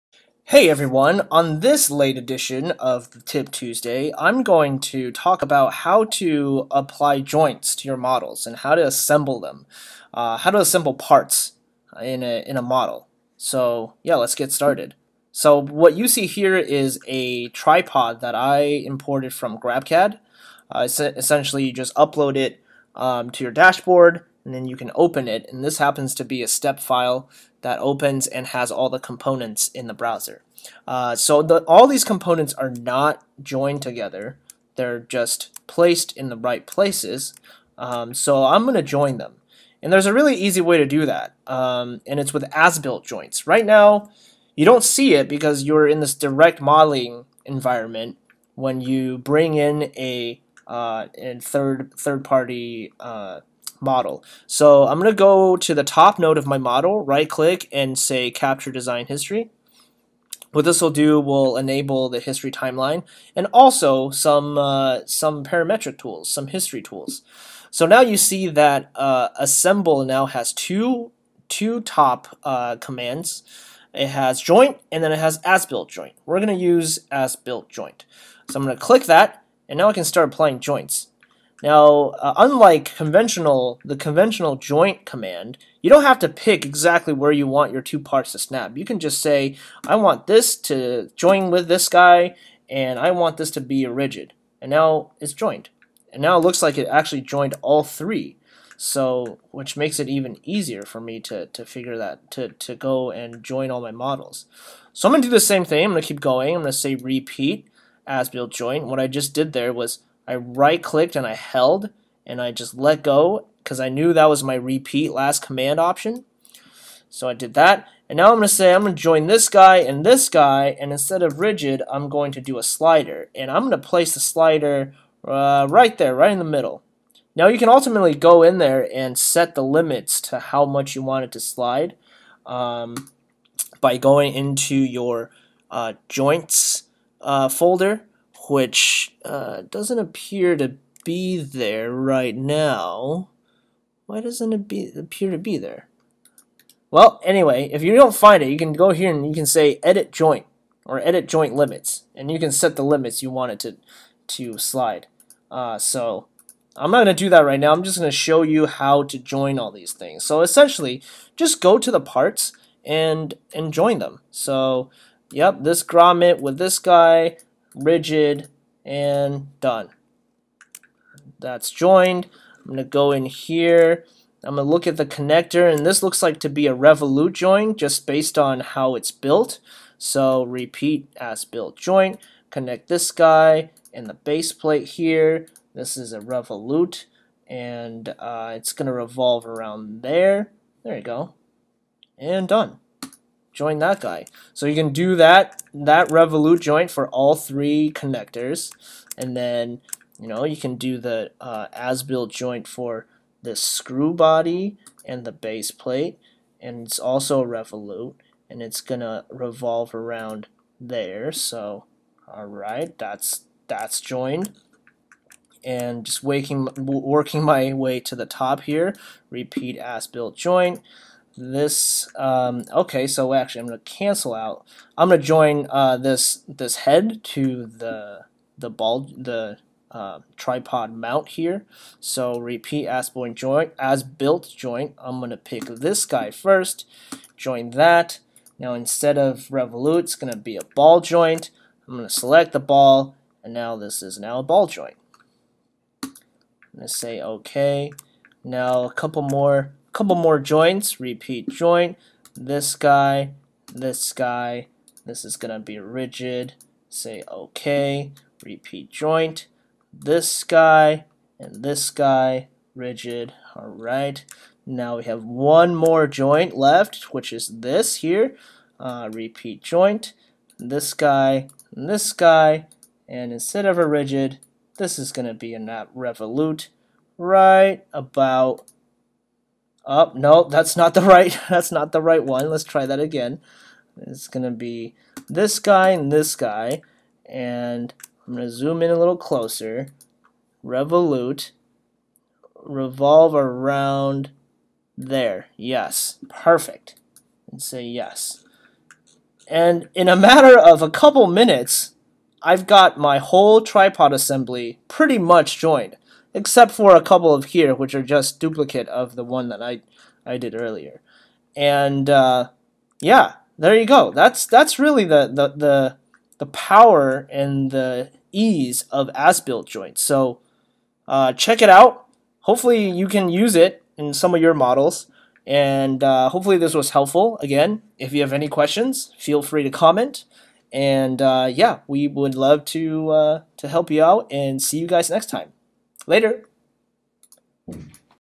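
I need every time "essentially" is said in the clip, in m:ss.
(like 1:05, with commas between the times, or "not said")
0:20, 2:40.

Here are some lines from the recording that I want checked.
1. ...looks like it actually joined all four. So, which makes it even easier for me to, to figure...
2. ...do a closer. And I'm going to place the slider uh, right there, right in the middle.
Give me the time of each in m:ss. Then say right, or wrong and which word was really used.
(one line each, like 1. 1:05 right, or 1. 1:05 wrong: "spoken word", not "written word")
1. 1:36 wrong: "three", not "four"
2. 2:02 wrong: "slider", not "closer".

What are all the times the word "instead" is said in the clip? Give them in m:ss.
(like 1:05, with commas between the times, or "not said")
2:00, 3:58, 4:33.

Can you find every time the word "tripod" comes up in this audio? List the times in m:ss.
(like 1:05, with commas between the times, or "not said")
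0:17, 3:50, 5:03.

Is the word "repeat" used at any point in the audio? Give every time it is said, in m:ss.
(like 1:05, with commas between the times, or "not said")
1:46, 1:54, 3:00, 3:39, 3:52, 4:10, 4:18, 4:29.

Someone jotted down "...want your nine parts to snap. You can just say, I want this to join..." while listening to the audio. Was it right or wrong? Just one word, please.
wrong.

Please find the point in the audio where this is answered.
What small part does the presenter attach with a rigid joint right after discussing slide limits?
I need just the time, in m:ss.
2:45.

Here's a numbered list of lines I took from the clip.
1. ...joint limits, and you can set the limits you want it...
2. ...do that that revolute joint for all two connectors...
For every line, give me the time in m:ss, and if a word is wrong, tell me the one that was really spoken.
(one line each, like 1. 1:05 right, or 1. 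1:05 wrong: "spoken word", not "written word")
1. 2:31 right
2. 3:14 wrong: "three", not "two".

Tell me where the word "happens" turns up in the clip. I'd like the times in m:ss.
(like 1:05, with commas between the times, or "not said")
0:25.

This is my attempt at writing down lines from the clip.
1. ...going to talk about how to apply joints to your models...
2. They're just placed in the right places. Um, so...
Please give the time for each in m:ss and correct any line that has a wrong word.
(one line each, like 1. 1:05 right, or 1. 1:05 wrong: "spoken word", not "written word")
1. 0:04 right
2. 0:34 right.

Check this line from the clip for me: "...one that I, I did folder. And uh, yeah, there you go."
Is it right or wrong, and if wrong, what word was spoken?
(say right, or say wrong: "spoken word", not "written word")
wrong: "earlier", not "folder".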